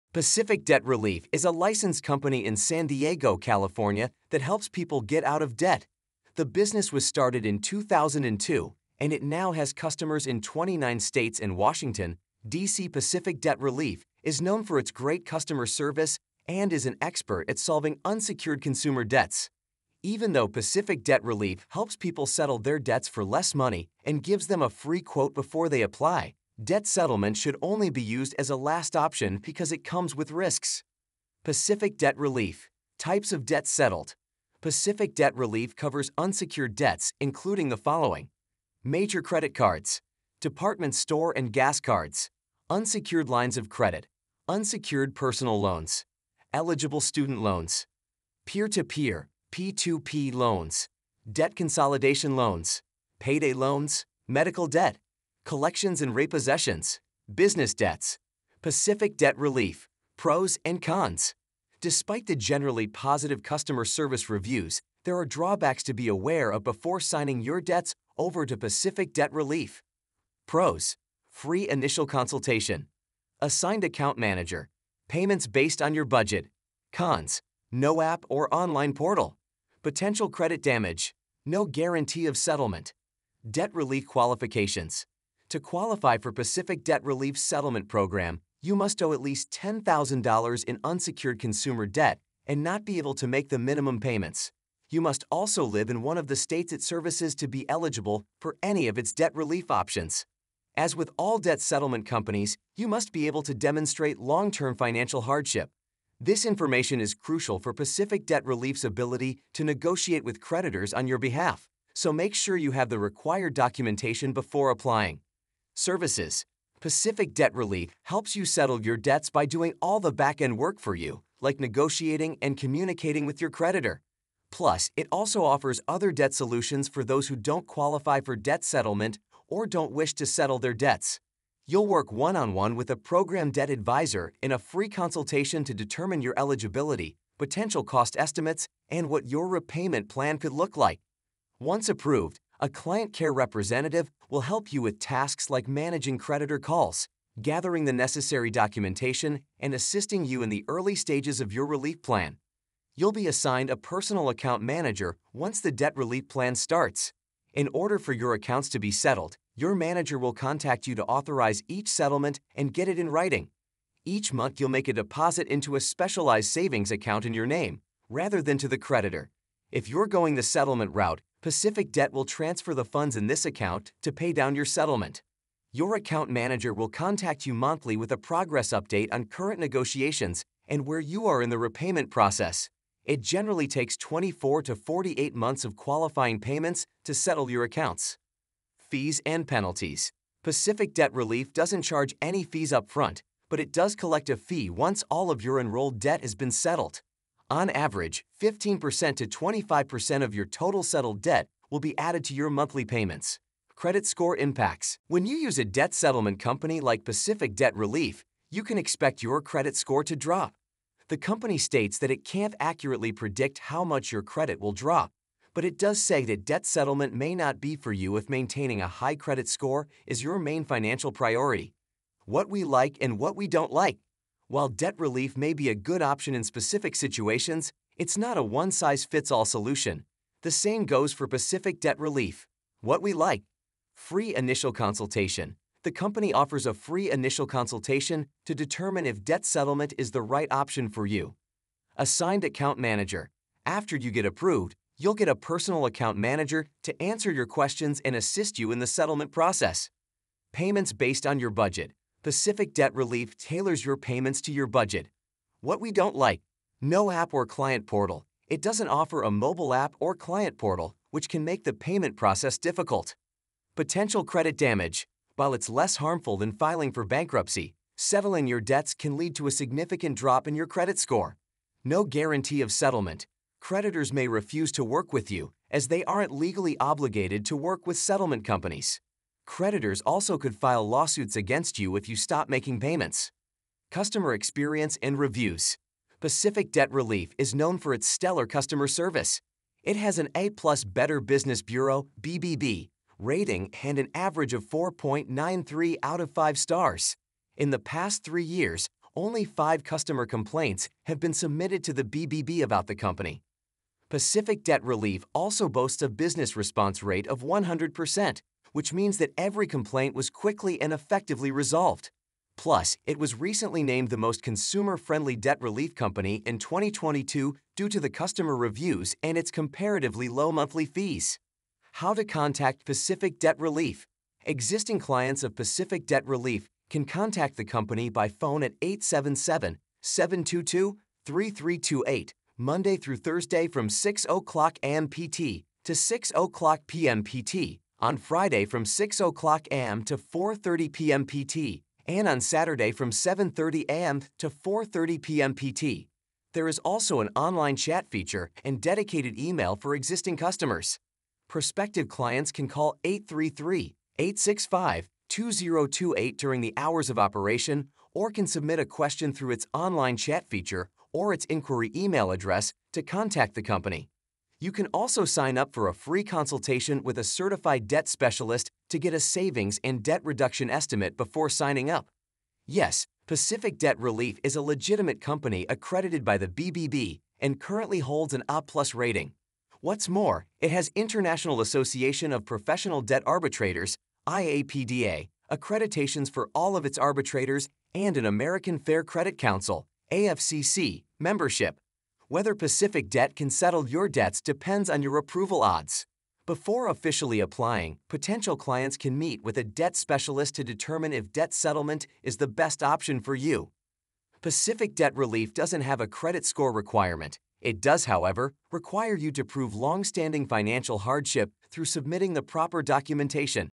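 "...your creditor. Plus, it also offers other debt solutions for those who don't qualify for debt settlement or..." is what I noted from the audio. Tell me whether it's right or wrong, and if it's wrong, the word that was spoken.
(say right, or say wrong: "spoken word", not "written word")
right.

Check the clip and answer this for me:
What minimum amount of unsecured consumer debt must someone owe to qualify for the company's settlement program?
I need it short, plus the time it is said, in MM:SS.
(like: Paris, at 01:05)
$10,000, at 01:29.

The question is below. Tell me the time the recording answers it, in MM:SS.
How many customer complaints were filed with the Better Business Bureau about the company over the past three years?
04:59.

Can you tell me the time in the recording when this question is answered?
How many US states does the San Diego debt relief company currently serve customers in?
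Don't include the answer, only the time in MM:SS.
00:10.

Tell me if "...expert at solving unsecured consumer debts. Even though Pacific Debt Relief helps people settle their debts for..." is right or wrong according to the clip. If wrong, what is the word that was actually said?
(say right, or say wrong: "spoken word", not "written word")
right.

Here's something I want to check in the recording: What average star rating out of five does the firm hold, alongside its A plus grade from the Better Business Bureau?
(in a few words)
4.93.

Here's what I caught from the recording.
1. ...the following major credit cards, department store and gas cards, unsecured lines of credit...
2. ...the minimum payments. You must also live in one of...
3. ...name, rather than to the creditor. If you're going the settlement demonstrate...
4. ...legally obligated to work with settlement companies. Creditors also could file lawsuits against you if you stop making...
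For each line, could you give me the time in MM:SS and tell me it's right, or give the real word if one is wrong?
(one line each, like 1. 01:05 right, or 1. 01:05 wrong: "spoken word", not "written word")
1. 00:37 right
2. 01:33 right
3. 02:47 wrong: "route", not "demonstrate"
4. 04:36 right.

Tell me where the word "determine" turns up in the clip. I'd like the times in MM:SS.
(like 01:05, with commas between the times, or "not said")
02:15, 03:58, 06:40.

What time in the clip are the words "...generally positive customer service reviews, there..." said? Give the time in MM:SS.
01:02.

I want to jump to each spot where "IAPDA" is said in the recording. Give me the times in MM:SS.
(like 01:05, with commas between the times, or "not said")
06:24.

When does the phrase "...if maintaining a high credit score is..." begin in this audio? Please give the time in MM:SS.
03:38.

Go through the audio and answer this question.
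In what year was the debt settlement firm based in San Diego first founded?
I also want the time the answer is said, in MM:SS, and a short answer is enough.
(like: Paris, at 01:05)
2002, at 00:07.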